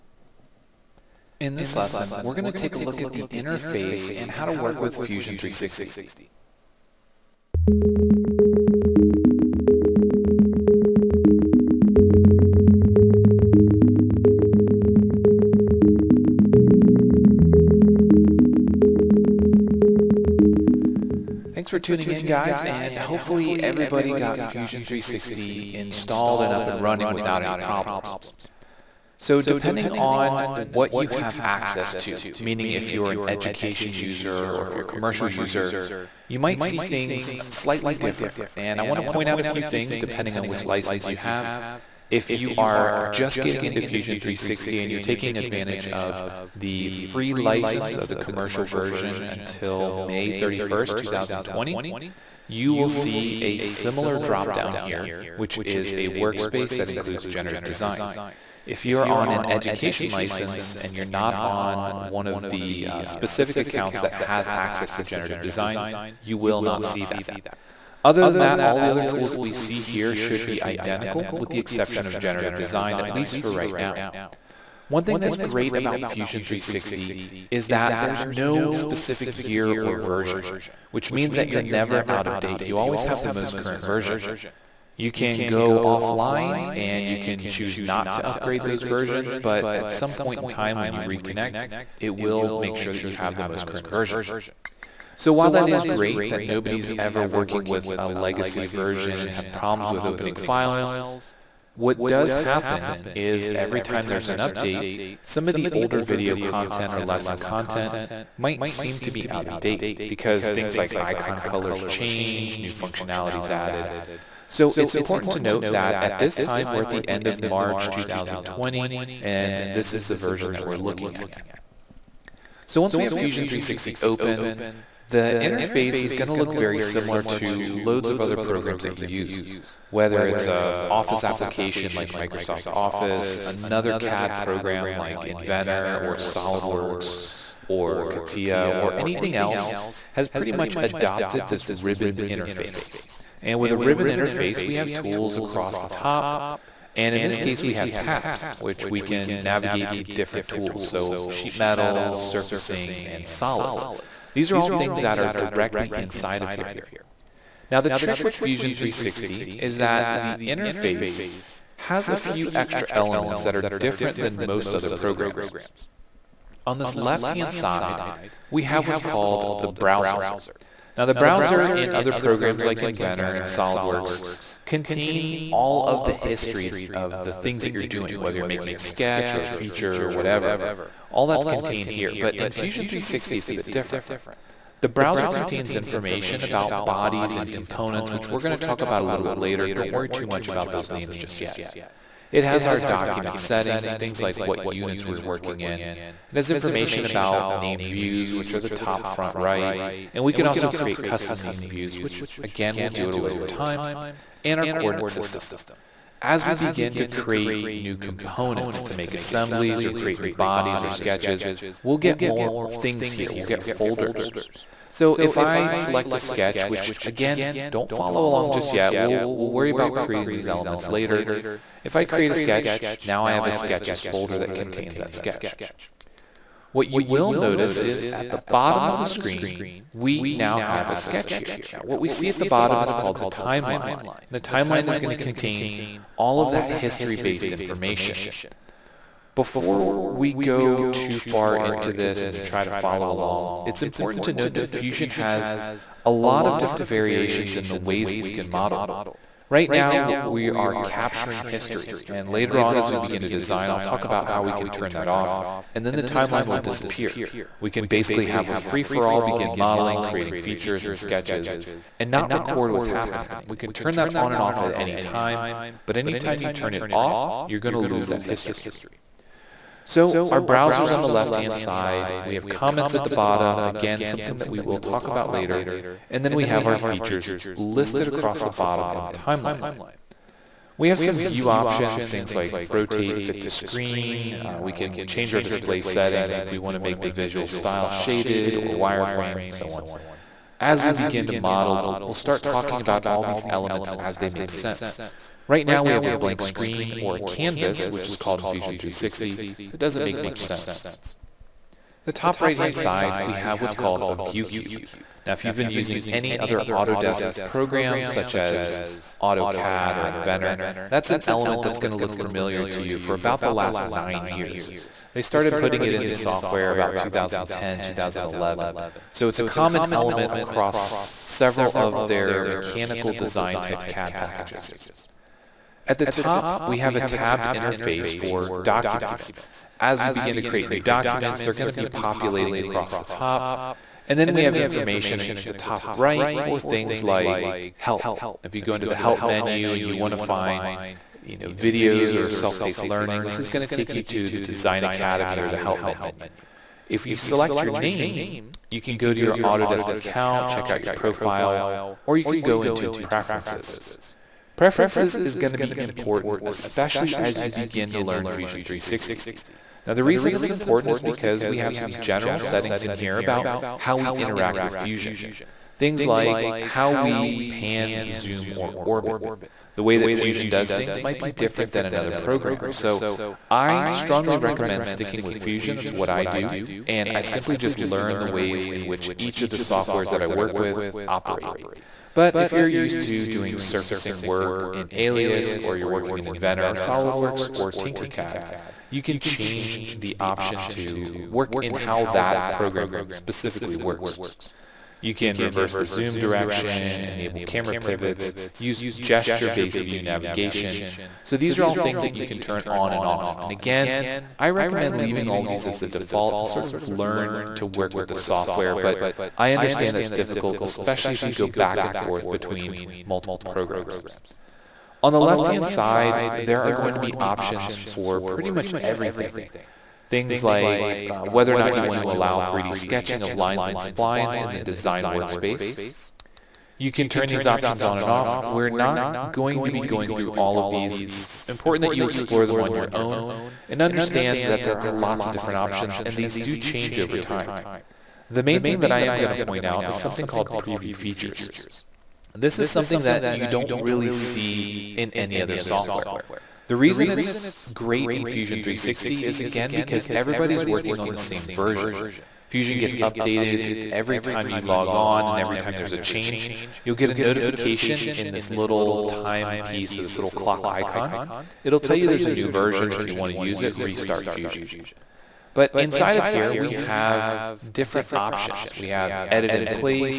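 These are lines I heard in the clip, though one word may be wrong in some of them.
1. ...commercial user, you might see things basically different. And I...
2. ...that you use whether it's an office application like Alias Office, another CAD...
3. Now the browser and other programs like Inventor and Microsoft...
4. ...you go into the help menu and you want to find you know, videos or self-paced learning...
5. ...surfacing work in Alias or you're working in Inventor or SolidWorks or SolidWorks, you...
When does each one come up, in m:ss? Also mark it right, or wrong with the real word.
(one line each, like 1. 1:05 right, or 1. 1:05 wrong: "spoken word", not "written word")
1. 0:34 wrong: "slightly", not "basically"
2. 2:08 wrong: "Microsoft", not "Alias"
3. 2:50 wrong: "SolidWorks", not "Microsoft"
4. 5:38 right
5. 6:23 wrong: "Tinkercad", not "SolidWorks".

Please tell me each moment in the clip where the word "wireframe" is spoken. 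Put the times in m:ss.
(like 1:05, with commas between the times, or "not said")
4:48.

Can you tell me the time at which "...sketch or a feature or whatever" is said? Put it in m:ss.
2:58.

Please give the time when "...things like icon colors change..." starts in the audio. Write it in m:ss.
1:50.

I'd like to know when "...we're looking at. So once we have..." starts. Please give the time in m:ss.
2:00.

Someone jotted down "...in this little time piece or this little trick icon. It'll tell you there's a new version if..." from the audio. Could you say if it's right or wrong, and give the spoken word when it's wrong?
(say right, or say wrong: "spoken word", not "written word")
wrong: "clock", not "trick".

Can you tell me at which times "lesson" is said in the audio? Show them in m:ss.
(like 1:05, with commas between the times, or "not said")
0:01, 1:47.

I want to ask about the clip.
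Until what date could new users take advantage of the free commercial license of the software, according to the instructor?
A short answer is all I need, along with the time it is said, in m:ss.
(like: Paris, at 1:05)
May 31st, 2020, at 0:49.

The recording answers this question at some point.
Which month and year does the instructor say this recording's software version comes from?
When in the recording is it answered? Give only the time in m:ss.
1:57.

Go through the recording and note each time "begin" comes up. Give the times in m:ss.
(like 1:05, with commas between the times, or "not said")
3:26, 4:12, 4:19, 4:50, 5:30, 5:57.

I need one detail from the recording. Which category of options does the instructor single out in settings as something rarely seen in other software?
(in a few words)
Preview features.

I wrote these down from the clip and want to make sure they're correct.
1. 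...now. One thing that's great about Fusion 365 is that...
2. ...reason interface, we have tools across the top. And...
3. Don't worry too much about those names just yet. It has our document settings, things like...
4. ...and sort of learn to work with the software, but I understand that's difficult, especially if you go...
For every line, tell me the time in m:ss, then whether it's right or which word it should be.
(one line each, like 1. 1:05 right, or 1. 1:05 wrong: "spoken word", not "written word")
1. 1:13 wrong: "360", not "365"
2. 2:23 wrong: "ribbon", not "reason"
3. 3:09 right
4. 6:46 right.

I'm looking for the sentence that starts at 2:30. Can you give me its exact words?
So sheet metal, surfacing, and solids.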